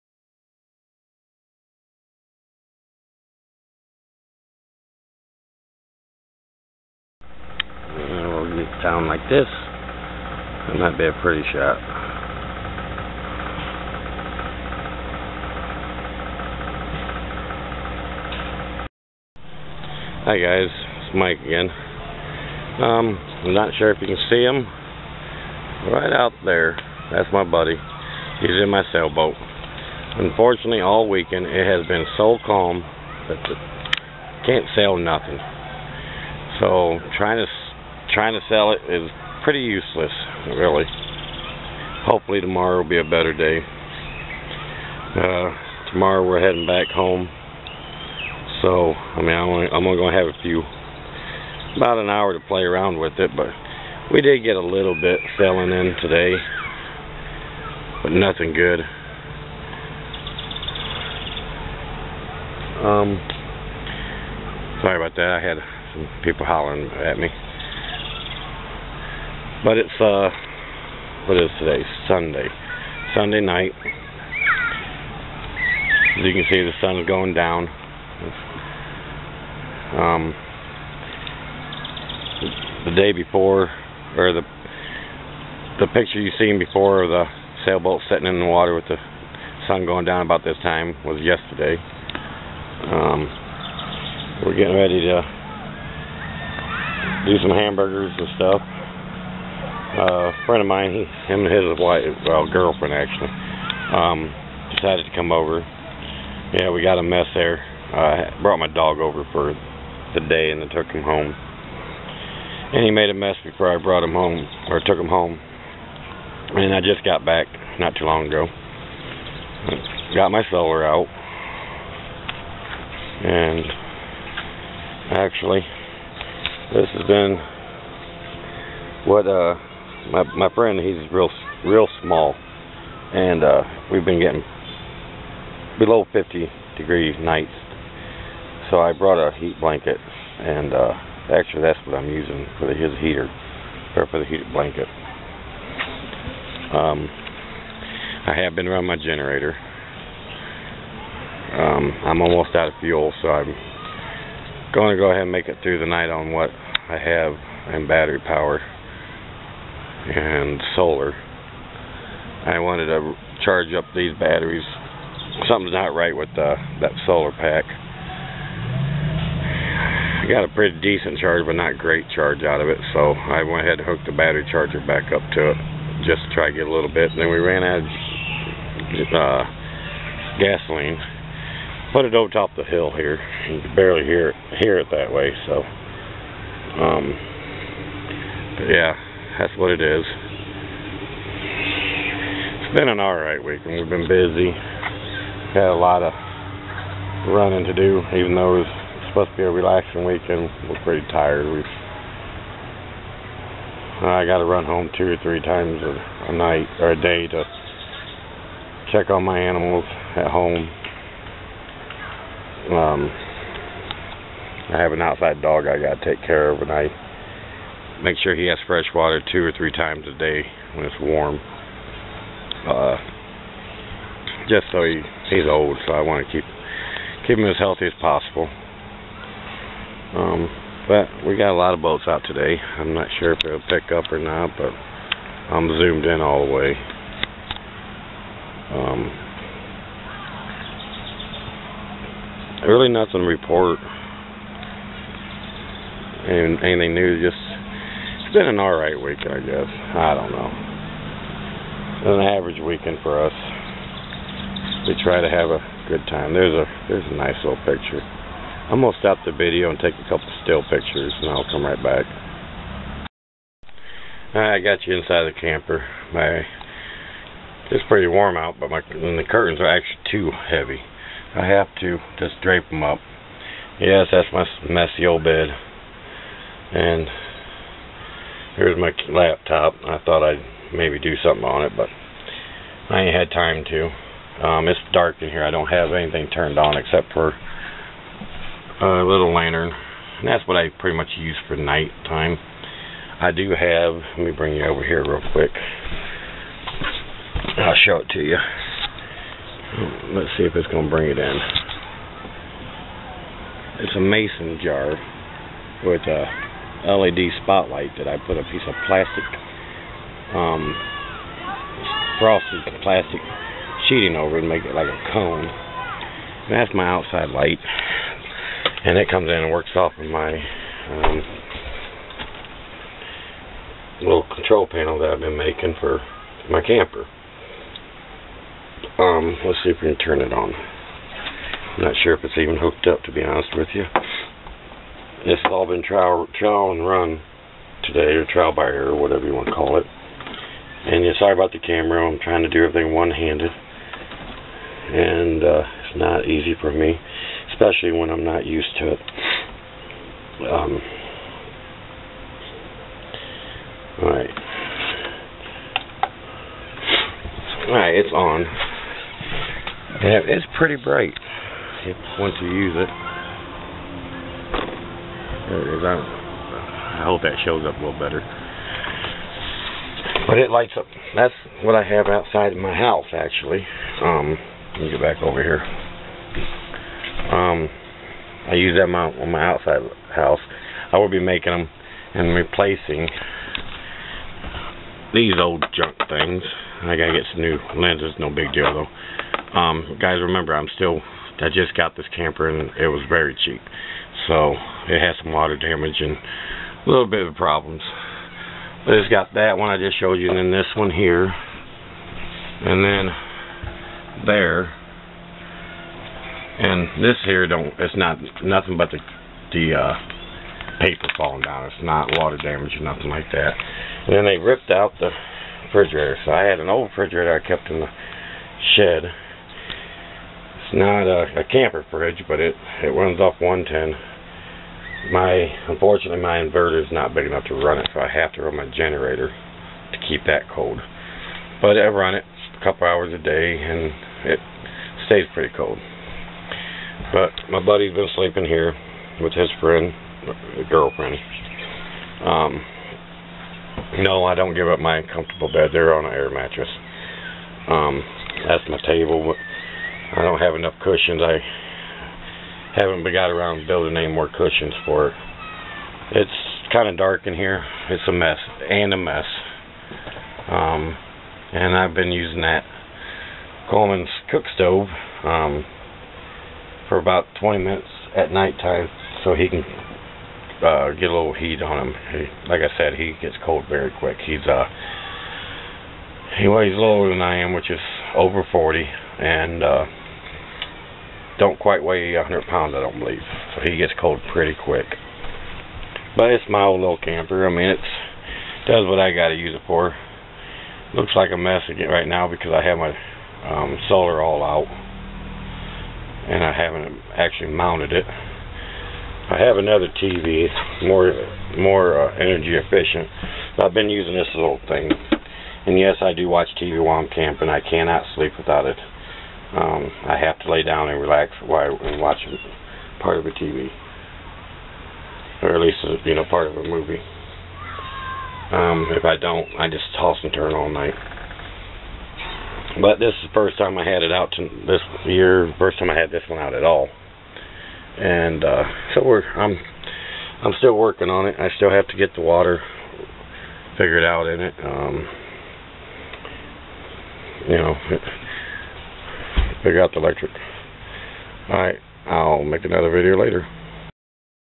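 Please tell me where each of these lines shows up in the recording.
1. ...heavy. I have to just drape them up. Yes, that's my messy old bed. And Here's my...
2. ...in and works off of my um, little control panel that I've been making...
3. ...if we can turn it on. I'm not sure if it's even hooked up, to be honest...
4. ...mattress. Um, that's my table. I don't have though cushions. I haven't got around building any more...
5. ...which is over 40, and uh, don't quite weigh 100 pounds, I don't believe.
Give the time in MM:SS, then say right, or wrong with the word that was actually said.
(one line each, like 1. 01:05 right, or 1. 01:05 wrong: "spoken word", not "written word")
1. 04:30 right
2. 05:19 right
3. 05:29 right
4. 07:26 wrong: "enough", not "though"
5. 07:57 right.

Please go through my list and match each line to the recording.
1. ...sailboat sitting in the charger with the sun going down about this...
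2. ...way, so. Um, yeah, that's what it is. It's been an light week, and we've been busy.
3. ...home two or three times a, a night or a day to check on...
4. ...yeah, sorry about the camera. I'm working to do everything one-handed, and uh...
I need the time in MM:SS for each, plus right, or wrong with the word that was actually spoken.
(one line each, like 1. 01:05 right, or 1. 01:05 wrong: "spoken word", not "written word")
1. 01:27 wrong: "water", not "charger"
2. 03:05 wrong: "alright", not "light"
3. 03:24 right
4. 05:41 wrong: "trying", not "working".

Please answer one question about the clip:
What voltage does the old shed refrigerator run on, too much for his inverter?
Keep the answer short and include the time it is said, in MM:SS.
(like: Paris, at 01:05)
110, at 07:03.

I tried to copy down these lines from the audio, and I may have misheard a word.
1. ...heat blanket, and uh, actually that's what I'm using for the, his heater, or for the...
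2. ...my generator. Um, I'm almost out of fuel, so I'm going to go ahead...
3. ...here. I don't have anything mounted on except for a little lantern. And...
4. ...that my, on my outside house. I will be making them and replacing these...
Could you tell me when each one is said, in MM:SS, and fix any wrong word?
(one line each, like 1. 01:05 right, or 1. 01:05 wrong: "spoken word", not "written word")
1. 02:19 right
2. 02:28 right
3. 04:45 wrong: "turned", not "mounted"
4. 06:18 right.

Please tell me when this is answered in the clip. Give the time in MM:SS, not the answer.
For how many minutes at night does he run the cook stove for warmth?
07:47.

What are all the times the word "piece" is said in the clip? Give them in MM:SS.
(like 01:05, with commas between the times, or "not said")
05:08.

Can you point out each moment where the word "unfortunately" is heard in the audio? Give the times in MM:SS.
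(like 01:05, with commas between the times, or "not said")
00:30, 07:05.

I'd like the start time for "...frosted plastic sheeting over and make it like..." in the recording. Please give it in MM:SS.
05:12.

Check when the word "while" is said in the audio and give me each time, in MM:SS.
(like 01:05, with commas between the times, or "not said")
08:26, 08:31.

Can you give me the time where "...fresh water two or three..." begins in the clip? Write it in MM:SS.
03:38.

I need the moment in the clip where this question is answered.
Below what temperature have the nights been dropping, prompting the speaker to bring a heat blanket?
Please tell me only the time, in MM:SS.
02:16.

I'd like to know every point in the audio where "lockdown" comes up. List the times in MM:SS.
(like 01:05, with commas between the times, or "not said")
not said.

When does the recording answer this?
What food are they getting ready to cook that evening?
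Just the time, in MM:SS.
01:37.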